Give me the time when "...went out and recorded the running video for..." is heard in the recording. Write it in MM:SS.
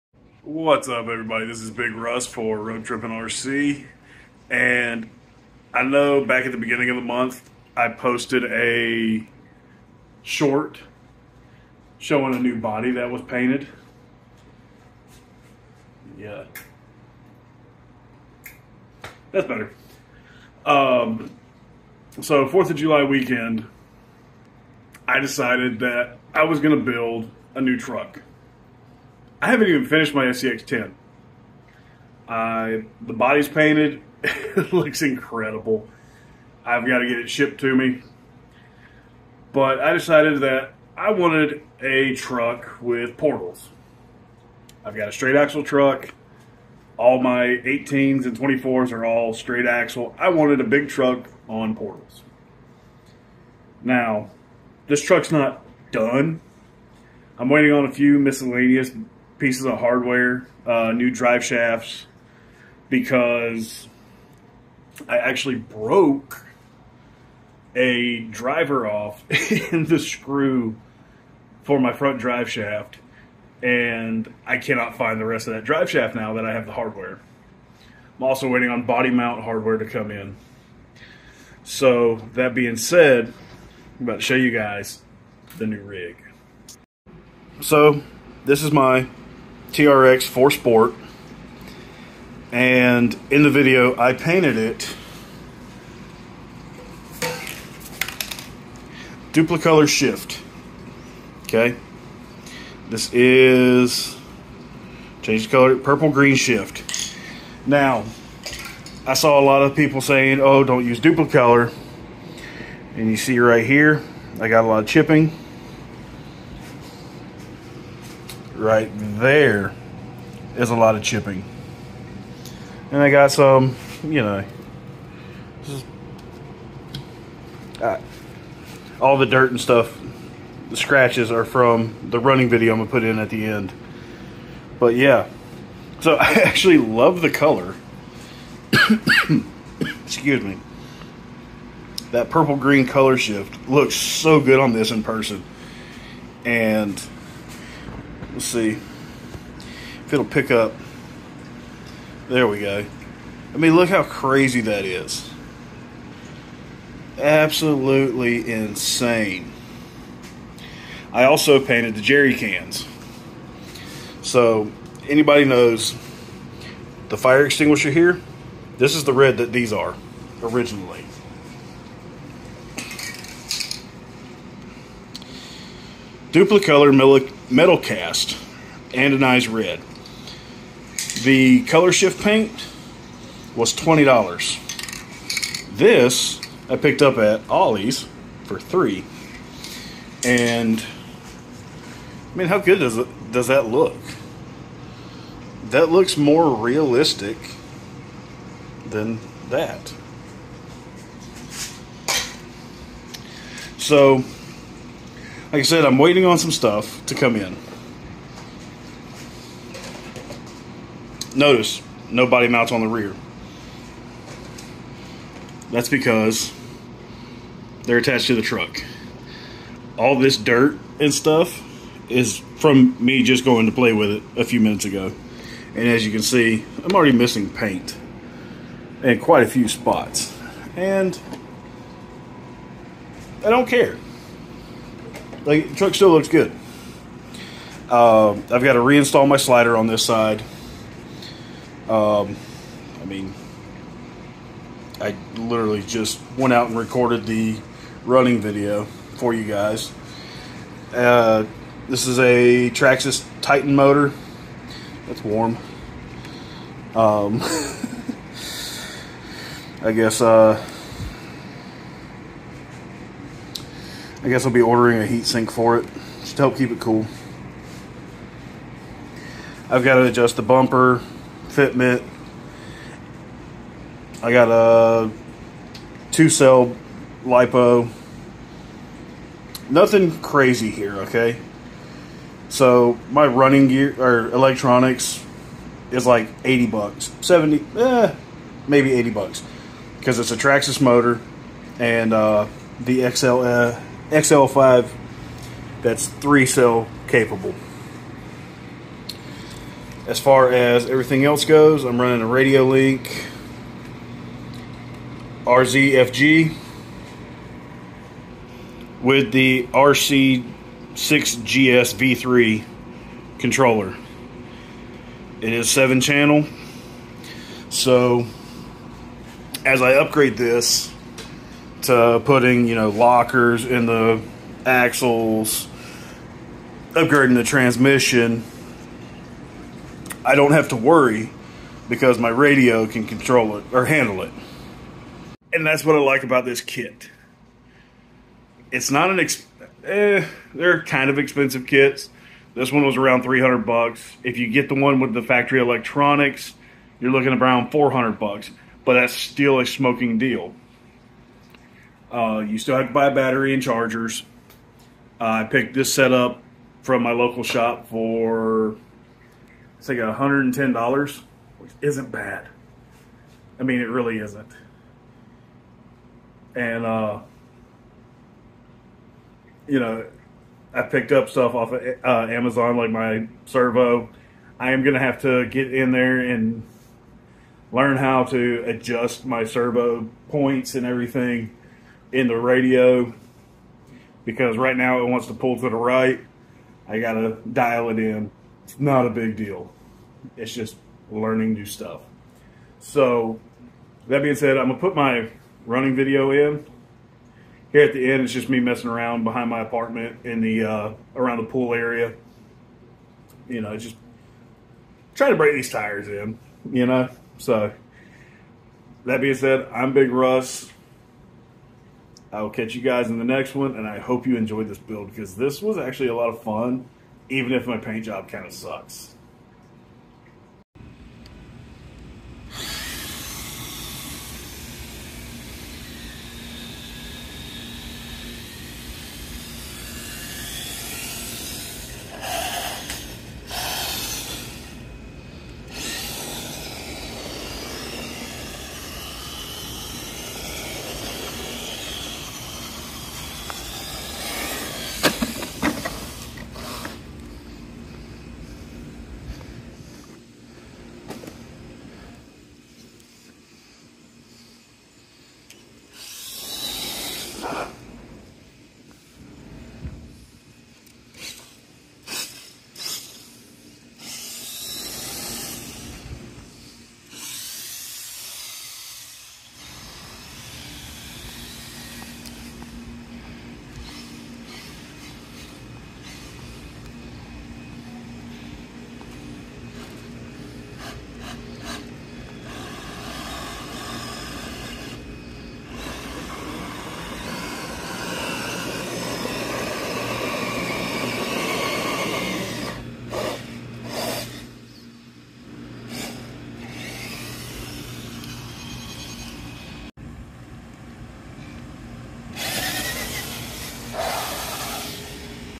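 04:06.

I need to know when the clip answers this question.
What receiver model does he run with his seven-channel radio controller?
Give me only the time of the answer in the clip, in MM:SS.
05:02.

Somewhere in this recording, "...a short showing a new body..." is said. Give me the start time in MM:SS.
00:08.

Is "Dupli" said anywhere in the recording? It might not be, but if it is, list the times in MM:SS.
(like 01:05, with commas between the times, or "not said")
01:39, 01:50, 02:56.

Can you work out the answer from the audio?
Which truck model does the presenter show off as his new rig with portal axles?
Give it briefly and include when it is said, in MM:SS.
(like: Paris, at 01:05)
TRX 4 Sport, at 01:29.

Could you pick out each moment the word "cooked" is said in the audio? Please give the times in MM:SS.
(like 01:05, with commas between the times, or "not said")
not said.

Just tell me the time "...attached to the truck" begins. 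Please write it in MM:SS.
03:37.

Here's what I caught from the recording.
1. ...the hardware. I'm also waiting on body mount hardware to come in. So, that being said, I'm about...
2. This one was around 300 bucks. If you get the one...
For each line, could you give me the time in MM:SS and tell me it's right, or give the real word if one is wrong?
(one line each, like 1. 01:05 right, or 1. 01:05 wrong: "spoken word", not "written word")
1. 01:16 right
2. 05:42 right.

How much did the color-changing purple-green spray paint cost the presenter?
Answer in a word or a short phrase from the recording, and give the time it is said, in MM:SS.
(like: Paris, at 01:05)
$20, at 03:03.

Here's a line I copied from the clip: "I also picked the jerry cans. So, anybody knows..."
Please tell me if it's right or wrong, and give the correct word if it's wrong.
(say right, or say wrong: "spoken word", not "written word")
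wrong: "painted", not "picked".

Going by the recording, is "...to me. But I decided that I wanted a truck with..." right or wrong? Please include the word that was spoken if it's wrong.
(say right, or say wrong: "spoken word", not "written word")
right.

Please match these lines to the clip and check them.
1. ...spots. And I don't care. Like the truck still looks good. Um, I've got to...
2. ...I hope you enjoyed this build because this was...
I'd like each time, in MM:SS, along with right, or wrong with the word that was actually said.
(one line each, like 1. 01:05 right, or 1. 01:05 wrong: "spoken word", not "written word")
1. 03:49 right
2. 06:53 right.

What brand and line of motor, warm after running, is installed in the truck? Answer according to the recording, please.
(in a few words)
Traxxas Titan.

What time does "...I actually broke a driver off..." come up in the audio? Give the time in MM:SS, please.
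01:05.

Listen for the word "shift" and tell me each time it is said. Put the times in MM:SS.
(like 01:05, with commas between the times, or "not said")
01:39, 01:46, 02:23, 03:01.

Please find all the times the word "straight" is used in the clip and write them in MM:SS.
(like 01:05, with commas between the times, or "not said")
00:45, 00:49.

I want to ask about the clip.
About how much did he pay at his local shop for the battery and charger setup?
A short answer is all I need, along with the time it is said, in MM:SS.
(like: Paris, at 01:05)
$110, at 05:59.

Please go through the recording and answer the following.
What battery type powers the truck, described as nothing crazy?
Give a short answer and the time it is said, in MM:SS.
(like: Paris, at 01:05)
two cell lipo, at 04:36.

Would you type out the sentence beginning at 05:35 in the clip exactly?
And that's what I like about this kit.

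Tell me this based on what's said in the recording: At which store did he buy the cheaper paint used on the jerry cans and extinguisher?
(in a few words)
Ollie's.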